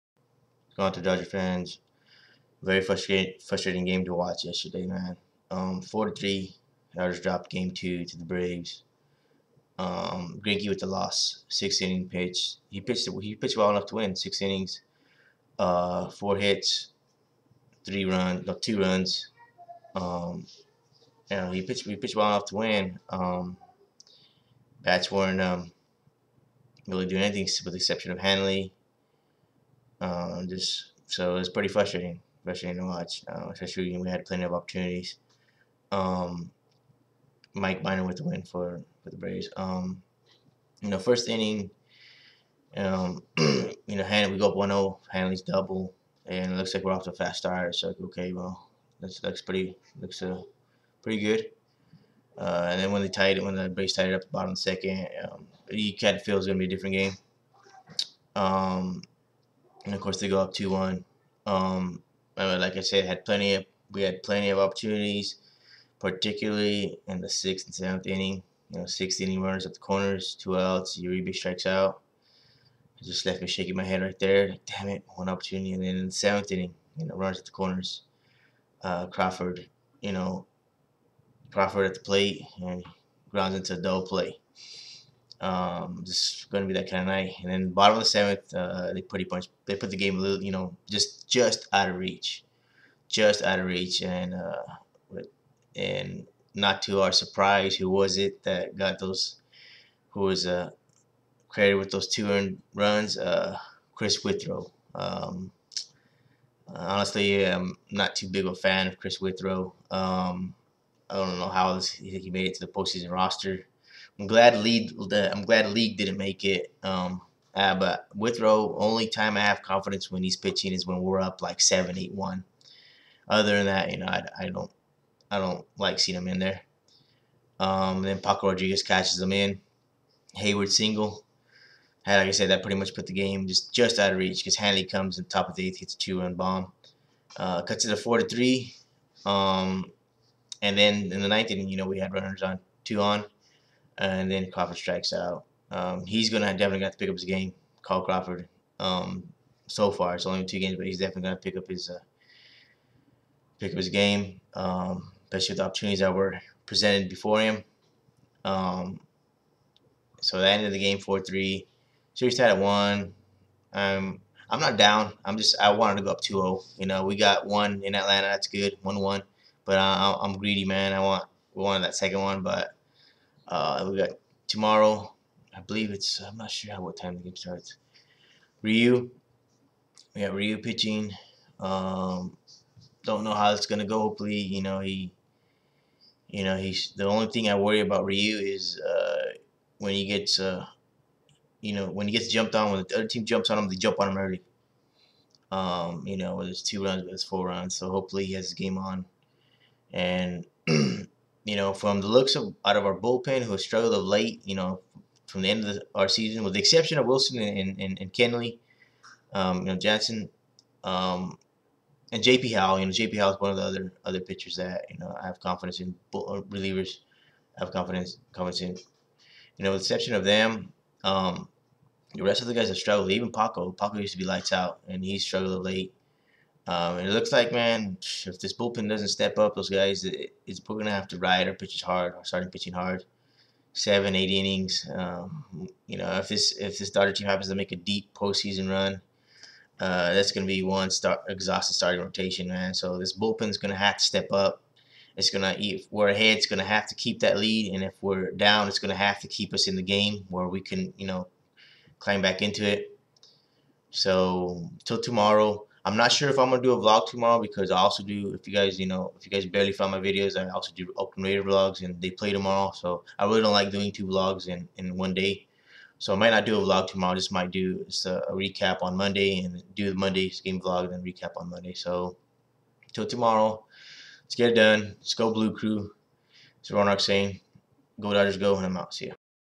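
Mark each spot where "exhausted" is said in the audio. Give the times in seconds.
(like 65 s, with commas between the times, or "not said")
241 s.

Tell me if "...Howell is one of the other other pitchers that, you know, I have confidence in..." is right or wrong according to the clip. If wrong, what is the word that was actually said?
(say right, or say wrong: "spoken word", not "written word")
right.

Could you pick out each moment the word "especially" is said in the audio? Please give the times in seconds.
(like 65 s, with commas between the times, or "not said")
33 s, 155 s.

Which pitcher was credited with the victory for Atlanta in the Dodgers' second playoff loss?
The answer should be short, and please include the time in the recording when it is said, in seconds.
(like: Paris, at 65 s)
Mike Miner, at 37 s.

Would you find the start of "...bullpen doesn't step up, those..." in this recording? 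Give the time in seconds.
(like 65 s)
228 s.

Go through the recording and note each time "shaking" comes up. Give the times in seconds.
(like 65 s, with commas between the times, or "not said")
73 s.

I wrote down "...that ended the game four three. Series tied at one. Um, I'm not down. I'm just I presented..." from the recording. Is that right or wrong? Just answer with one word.
wrong.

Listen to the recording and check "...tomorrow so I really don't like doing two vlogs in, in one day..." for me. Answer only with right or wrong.
right.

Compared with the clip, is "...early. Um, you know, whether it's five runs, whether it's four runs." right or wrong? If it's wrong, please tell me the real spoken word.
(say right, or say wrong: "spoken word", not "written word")
wrong: "two", not "five".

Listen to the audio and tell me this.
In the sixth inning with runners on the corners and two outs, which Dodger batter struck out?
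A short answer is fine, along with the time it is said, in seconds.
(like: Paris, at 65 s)
Uribe, at 70 s.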